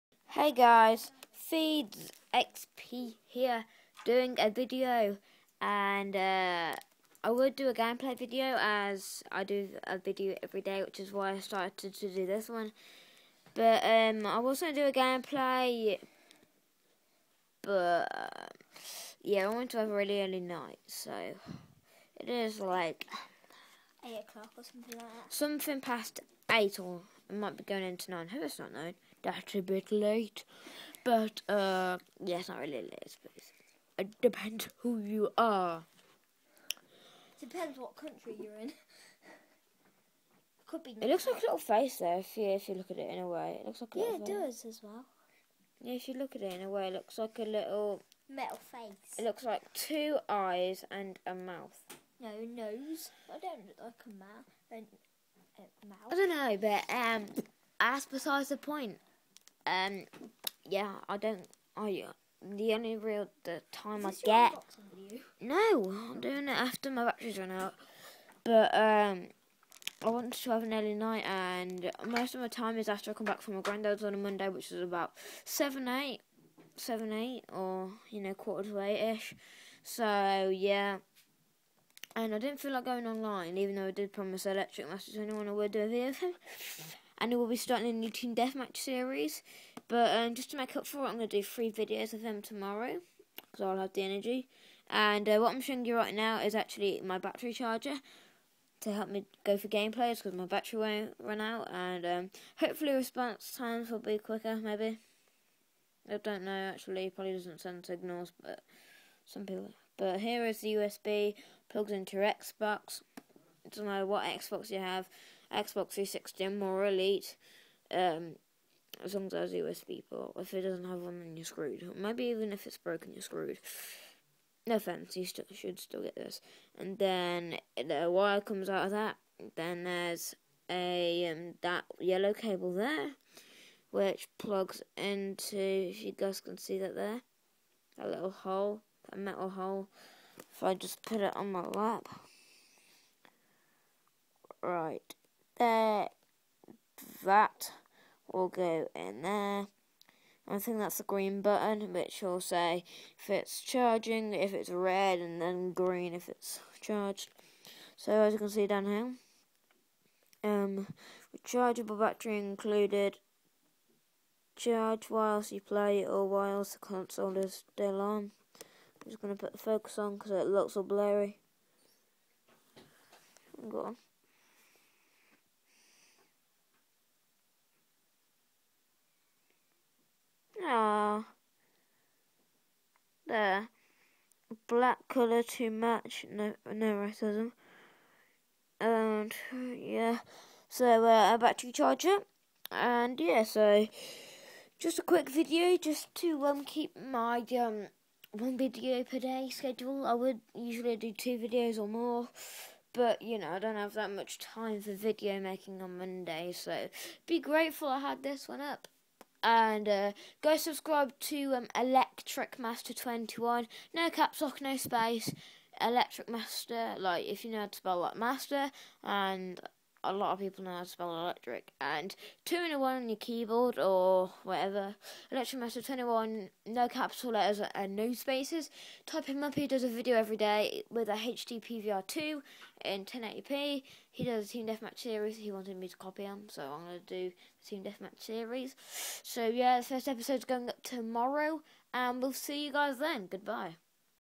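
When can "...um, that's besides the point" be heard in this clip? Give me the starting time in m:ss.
0:56.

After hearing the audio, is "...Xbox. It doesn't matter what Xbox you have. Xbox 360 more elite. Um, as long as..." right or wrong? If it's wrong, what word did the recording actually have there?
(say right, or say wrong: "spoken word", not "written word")
right.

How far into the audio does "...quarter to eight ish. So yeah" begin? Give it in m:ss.
1:18.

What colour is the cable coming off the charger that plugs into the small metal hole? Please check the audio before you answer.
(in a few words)
Yellow.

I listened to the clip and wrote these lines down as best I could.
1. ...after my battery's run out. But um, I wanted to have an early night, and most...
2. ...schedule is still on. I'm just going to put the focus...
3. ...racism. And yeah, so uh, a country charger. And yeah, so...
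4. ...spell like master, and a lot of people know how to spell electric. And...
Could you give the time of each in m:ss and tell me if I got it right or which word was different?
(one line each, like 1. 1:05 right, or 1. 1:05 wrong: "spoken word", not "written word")
1. 1:06 right
2. 2:46 wrong: "console", not "schedule"
3. 3:06 wrong: "battery", not "country"
4. 3:37 right.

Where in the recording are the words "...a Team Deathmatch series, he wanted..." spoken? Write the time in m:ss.
3:54.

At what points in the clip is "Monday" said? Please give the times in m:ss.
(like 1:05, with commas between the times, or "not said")
1:14, 3:25.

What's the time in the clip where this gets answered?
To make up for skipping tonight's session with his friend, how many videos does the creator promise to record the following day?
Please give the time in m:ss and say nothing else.
1:31.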